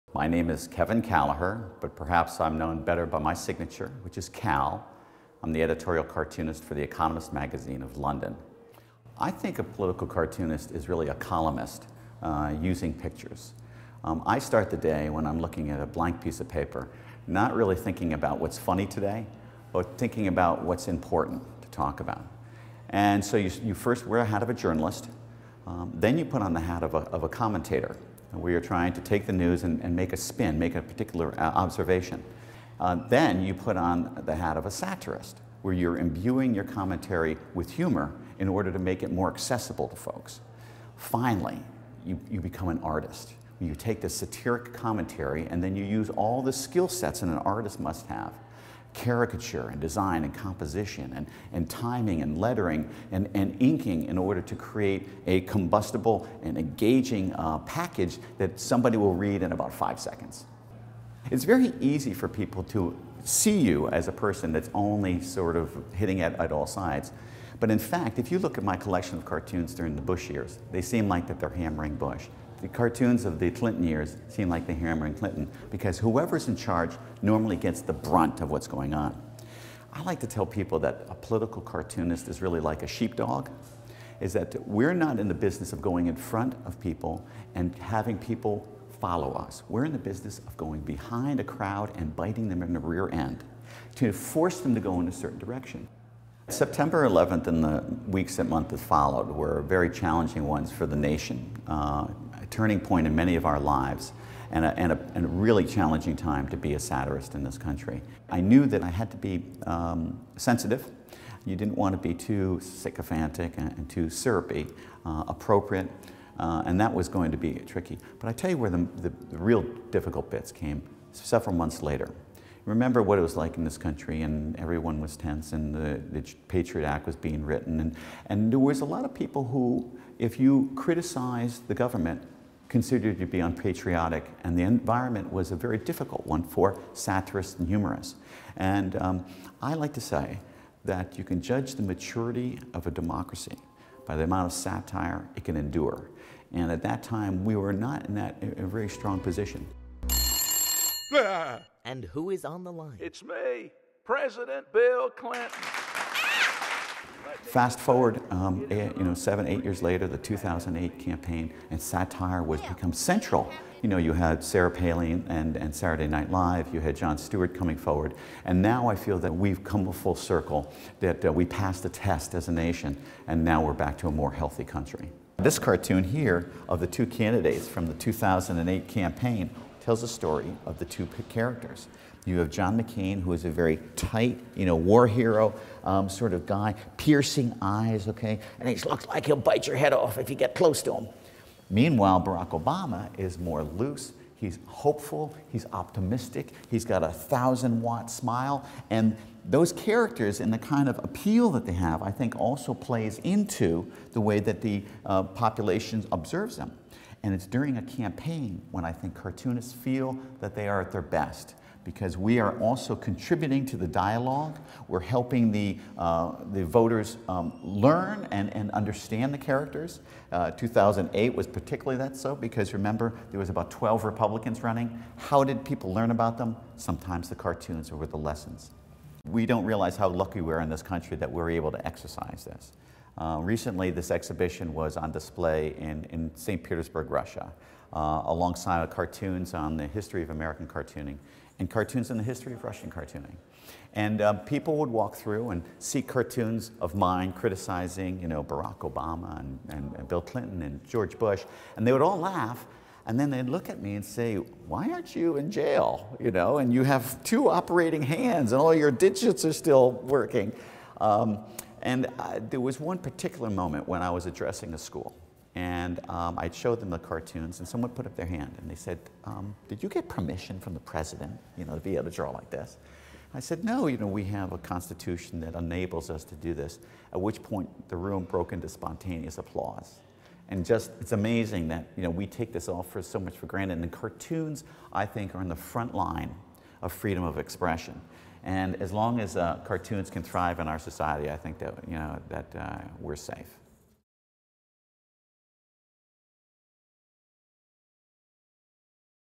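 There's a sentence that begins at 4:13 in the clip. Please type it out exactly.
And then they'd look at me and say, why aren't you in jail?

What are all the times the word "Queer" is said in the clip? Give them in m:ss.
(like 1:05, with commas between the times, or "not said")
not said.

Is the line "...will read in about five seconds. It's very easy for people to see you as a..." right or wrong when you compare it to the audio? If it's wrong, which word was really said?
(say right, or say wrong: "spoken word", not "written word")
right.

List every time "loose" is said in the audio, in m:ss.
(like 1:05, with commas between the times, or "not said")
3:13.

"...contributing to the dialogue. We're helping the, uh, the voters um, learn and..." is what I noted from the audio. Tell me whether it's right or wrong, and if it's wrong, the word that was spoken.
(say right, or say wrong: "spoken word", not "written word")
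right.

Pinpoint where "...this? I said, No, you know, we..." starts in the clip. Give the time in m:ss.
4:32.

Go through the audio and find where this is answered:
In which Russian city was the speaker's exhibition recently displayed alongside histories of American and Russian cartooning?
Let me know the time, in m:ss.
3:56.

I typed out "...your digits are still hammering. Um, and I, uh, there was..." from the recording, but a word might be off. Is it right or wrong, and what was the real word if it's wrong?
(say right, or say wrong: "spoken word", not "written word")
wrong: "working", not "hammering".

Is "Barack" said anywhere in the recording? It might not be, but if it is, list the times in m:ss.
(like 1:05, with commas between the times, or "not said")
3:12, 4:08.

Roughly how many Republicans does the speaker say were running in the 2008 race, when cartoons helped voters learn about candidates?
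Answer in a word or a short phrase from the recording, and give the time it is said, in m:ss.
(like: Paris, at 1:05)
12, at 3:43.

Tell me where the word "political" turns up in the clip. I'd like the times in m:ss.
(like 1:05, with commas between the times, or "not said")
0:09, 1:21.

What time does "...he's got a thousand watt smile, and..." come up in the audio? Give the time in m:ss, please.
3:16.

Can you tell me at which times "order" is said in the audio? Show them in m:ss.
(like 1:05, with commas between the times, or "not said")
0:38, 0:54.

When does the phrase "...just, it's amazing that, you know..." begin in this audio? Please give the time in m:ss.
4:40.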